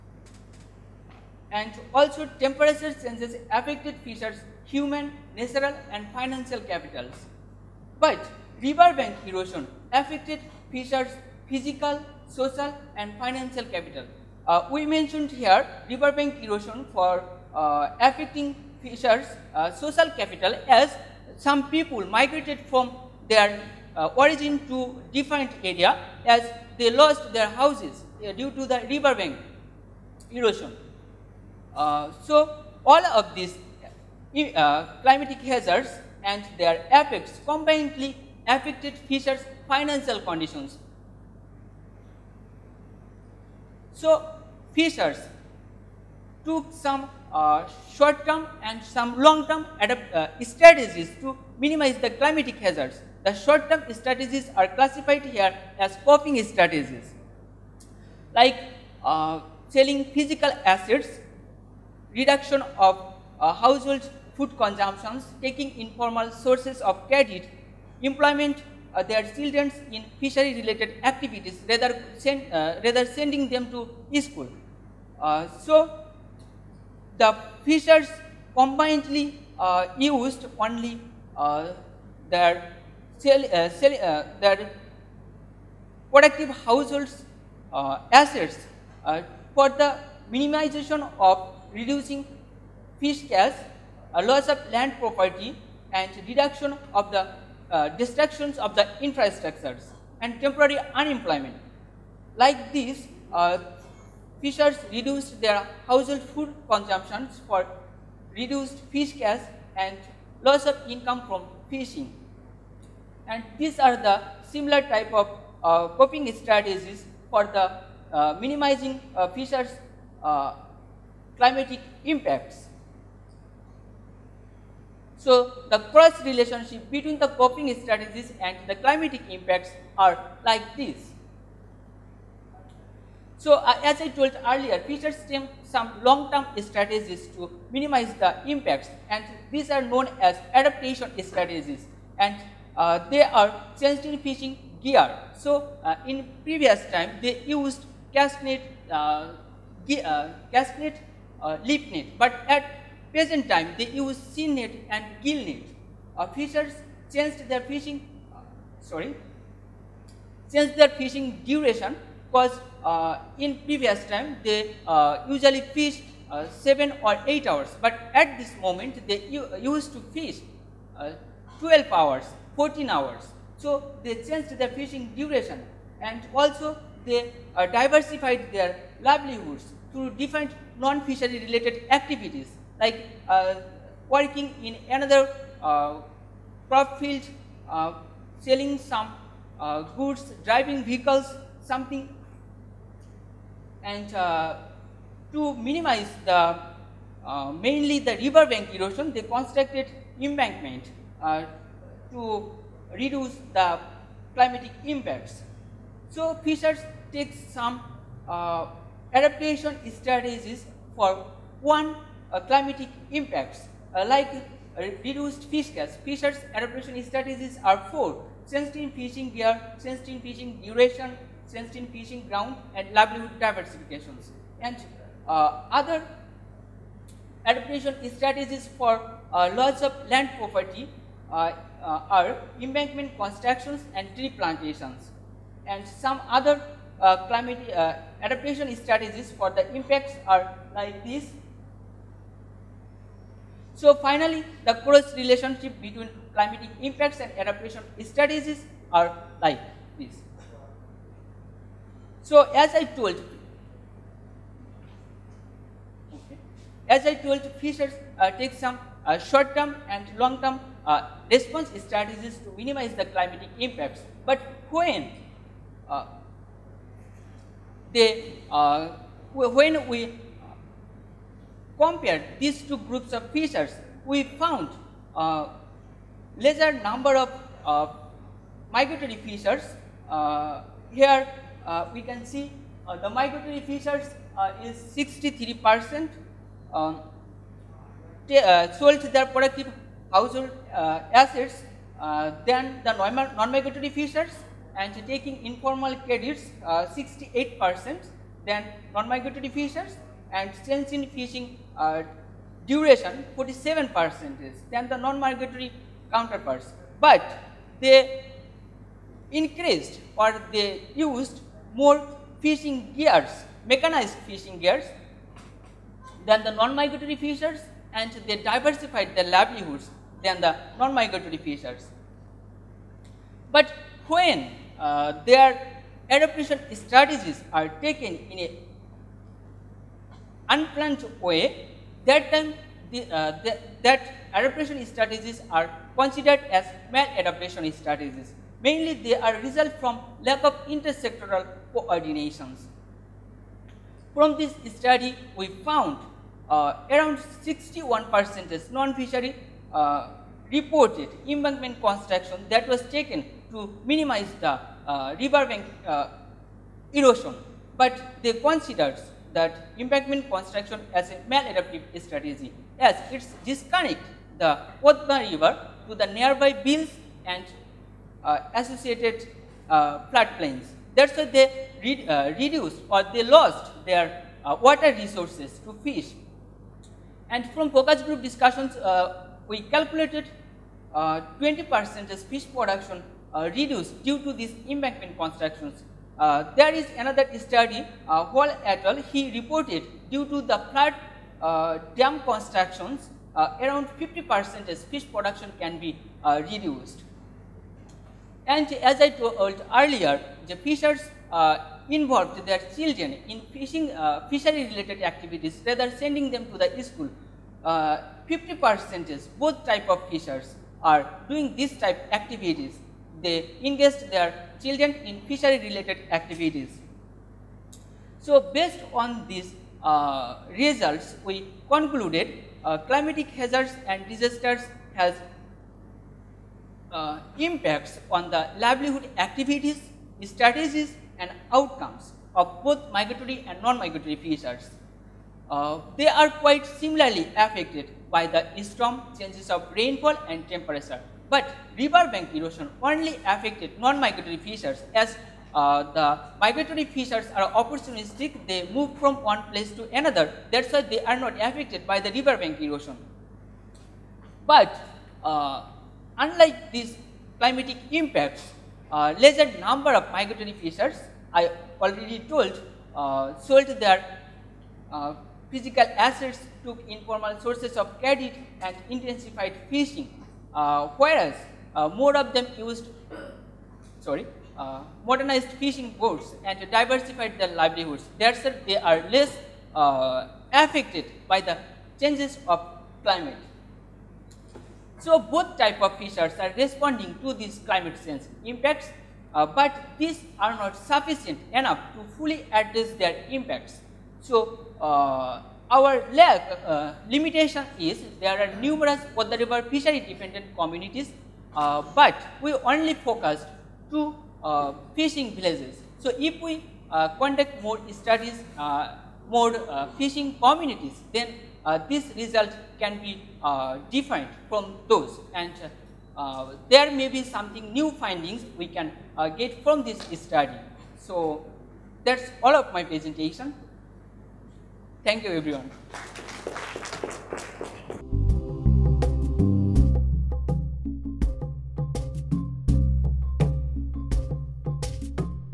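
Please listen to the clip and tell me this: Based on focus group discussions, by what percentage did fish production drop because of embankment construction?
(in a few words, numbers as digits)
20%.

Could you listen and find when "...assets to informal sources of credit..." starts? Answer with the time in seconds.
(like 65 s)
465 s.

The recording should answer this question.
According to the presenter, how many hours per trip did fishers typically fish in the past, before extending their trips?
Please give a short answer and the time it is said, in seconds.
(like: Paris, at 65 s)
7 or 8 hours, at 166 s.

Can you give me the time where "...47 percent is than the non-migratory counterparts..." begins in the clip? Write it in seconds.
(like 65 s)
303 s.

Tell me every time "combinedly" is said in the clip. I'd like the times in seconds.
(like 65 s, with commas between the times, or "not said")
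37 s, 78 s.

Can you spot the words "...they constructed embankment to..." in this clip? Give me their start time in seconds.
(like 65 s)
199 s.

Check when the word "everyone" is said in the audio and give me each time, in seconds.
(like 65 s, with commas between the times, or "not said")
525 s.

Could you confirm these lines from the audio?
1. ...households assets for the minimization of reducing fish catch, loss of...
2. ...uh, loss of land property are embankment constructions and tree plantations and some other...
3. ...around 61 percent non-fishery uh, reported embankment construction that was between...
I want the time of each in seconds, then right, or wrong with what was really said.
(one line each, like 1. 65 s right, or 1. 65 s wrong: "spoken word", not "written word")
1. 86 s right
2. 229 s right
3. 346 s wrong: "taken", not "between".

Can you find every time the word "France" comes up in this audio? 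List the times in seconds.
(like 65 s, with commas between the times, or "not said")
not said.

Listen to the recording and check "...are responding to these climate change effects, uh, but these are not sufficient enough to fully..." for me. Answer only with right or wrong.
wrong.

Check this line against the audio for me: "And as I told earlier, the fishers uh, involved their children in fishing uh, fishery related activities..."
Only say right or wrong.
right.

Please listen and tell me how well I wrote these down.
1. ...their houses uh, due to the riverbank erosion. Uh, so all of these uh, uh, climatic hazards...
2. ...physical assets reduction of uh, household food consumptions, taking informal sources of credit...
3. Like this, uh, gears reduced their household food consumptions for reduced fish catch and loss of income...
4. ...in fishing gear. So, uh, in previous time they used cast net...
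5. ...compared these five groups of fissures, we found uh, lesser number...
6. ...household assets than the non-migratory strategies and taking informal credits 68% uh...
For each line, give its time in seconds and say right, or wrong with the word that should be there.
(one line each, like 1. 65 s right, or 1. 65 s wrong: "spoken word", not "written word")
1. 27 s right
2. 60 s right
3. 102 s wrong: "fishers", not "gears"
4. 144 s right
5. 271 s wrong: "two", not "five"
6. 290 s wrong: "fissures", not "strategies".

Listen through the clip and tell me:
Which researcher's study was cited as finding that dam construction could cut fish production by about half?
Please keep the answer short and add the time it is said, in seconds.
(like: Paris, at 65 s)
Wall et al., at 388 s.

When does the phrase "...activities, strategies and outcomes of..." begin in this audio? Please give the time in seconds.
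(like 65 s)
429 s.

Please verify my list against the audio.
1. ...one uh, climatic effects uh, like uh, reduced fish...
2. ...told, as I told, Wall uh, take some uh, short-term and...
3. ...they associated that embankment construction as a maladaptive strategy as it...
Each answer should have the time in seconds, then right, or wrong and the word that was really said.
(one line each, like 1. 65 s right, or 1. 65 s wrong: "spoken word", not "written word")
1. 211 s wrong: "impacts", not "effects"
2. 252 s wrong: "Fisher", not "Wall"
3. 358 s wrong: "considered", not "associated".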